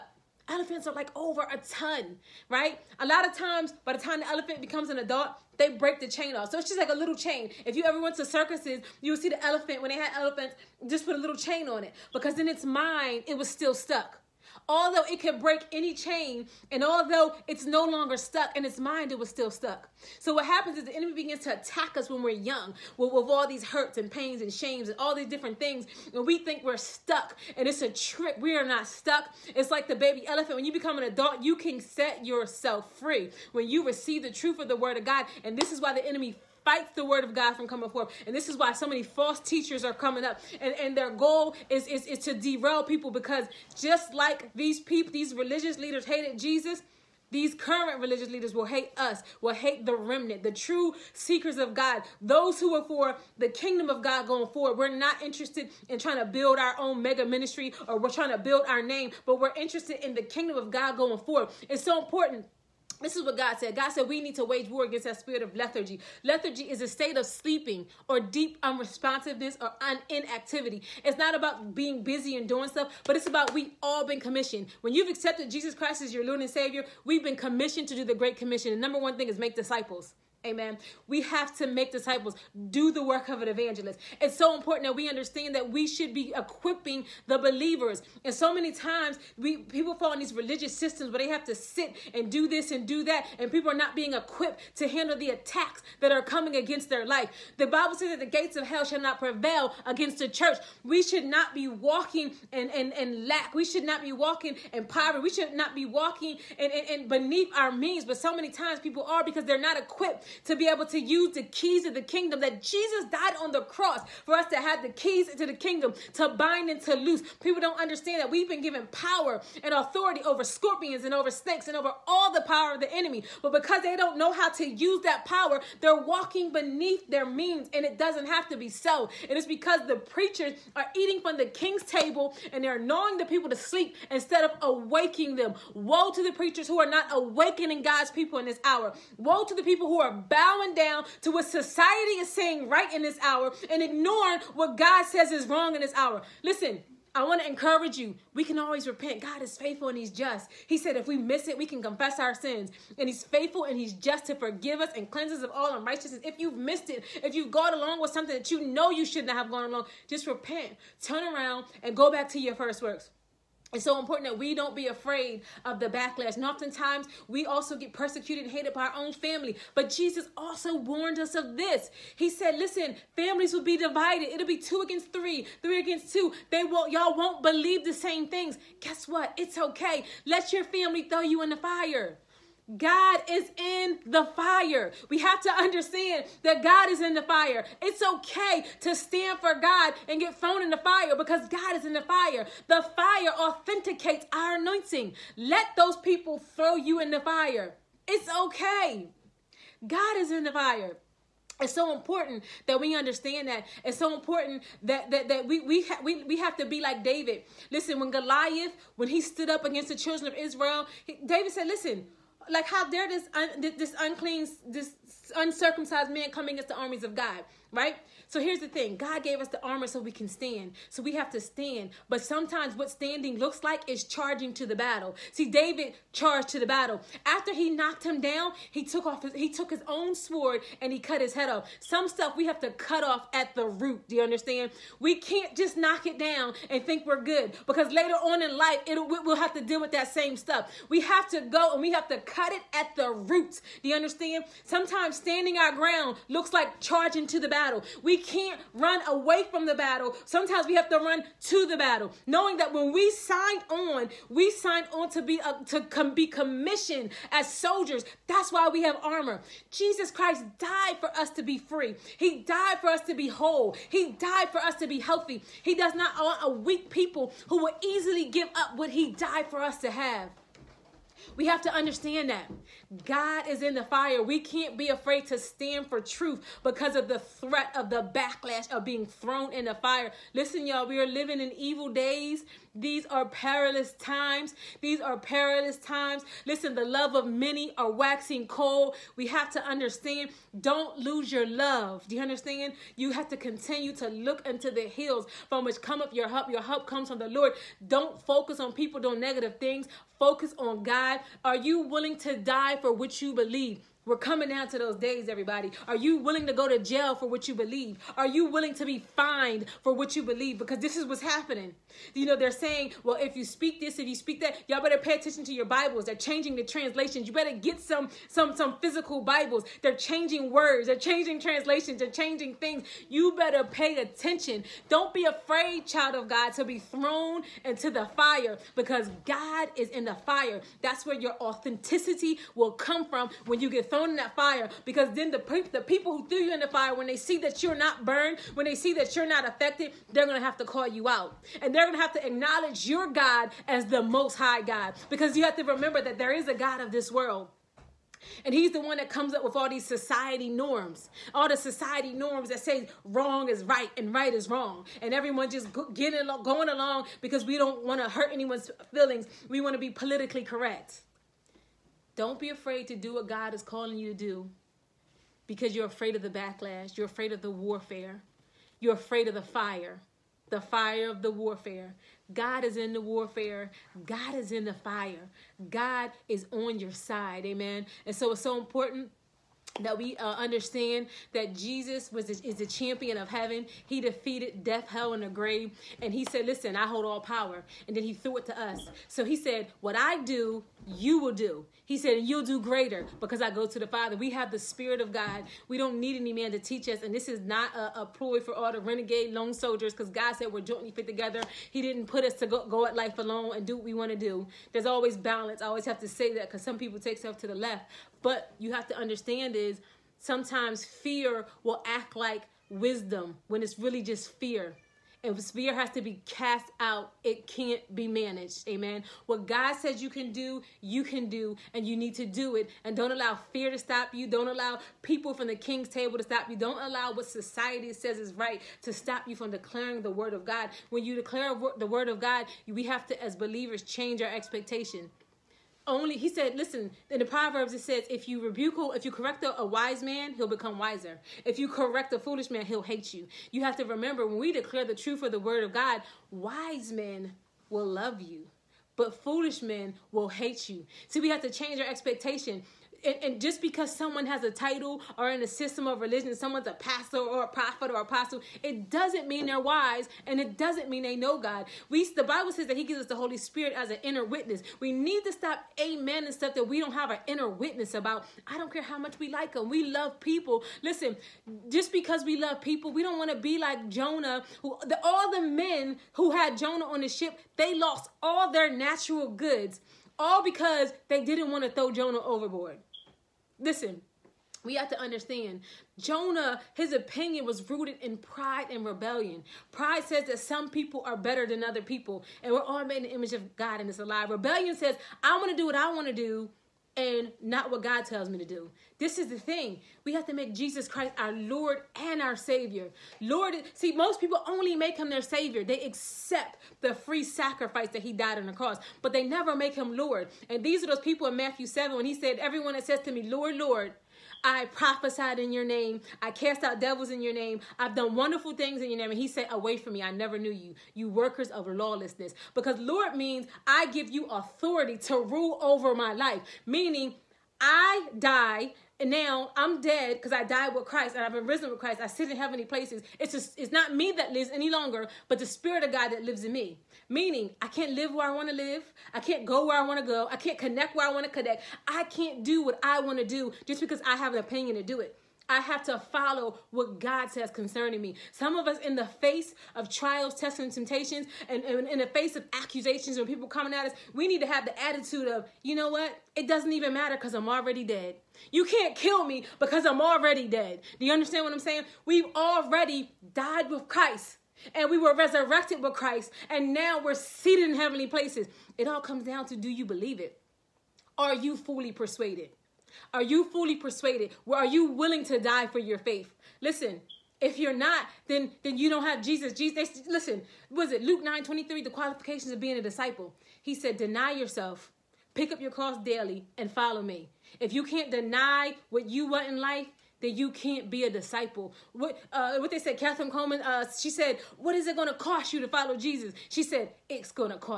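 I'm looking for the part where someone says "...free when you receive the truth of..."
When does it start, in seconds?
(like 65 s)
32 s.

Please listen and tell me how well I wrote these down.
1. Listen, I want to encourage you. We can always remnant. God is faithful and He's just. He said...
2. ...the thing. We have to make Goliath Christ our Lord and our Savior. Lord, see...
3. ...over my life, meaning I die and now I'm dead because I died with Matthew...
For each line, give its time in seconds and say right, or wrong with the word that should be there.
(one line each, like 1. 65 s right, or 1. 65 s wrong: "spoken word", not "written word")
1. 146 s wrong: "repent", not "remnant"
2. 499 s wrong: "Jesus", not "Goliath"
3. 525 s wrong: "Christ", not "Matthew".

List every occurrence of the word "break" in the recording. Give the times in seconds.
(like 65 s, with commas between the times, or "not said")
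5 s, 15 s.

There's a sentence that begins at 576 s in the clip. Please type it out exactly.
Listen, if you're not, then then you don't have Jesus.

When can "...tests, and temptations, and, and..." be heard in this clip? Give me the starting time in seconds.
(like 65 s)
550 s.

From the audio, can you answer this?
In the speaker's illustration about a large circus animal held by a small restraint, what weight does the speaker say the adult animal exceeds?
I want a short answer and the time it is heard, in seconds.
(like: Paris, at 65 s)
a ton, at 1 s.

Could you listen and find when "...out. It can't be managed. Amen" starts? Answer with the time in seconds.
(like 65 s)
416 s.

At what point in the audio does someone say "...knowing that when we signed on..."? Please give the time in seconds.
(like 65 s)
252 s.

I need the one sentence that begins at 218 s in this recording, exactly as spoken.
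So here's the thing God gave us the armor so we can stand.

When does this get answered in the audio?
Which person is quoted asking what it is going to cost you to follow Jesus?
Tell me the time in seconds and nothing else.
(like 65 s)
592 s.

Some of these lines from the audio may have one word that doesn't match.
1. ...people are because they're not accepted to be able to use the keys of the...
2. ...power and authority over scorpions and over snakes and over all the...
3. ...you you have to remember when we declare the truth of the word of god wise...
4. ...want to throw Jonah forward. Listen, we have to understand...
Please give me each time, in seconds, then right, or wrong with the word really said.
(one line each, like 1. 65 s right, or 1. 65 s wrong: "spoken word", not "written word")
1. 108 s wrong: "equipped", not "accepted"
2. 118 s right
3. 443 s right
4. 481 s wrong: "overboard", not "forward".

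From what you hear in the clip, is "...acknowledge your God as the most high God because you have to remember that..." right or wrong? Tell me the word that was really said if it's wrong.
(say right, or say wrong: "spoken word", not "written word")
right.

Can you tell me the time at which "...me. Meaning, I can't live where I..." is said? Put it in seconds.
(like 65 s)
536 s.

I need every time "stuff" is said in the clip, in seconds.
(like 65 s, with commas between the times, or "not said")
72 s, 232 s, 240 s, 407 s, 466 s.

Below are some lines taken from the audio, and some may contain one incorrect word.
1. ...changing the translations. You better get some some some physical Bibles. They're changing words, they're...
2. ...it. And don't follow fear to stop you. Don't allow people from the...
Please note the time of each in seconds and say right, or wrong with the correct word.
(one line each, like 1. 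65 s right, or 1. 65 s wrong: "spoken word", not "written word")
1. 316 s right
2. 422 s wrong: "allow", not "follow".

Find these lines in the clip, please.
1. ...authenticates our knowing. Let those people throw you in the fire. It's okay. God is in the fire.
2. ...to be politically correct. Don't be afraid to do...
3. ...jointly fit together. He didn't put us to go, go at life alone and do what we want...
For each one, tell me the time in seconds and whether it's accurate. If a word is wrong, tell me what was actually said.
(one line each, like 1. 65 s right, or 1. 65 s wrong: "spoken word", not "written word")
1. 193 s wrong: "anointing", not "knowing"
2. 359 s right
3. 400 s right.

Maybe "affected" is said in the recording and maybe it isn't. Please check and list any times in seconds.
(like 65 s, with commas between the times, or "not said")
339 s.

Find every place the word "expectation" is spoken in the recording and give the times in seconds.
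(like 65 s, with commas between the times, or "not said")
434 s, 451 s.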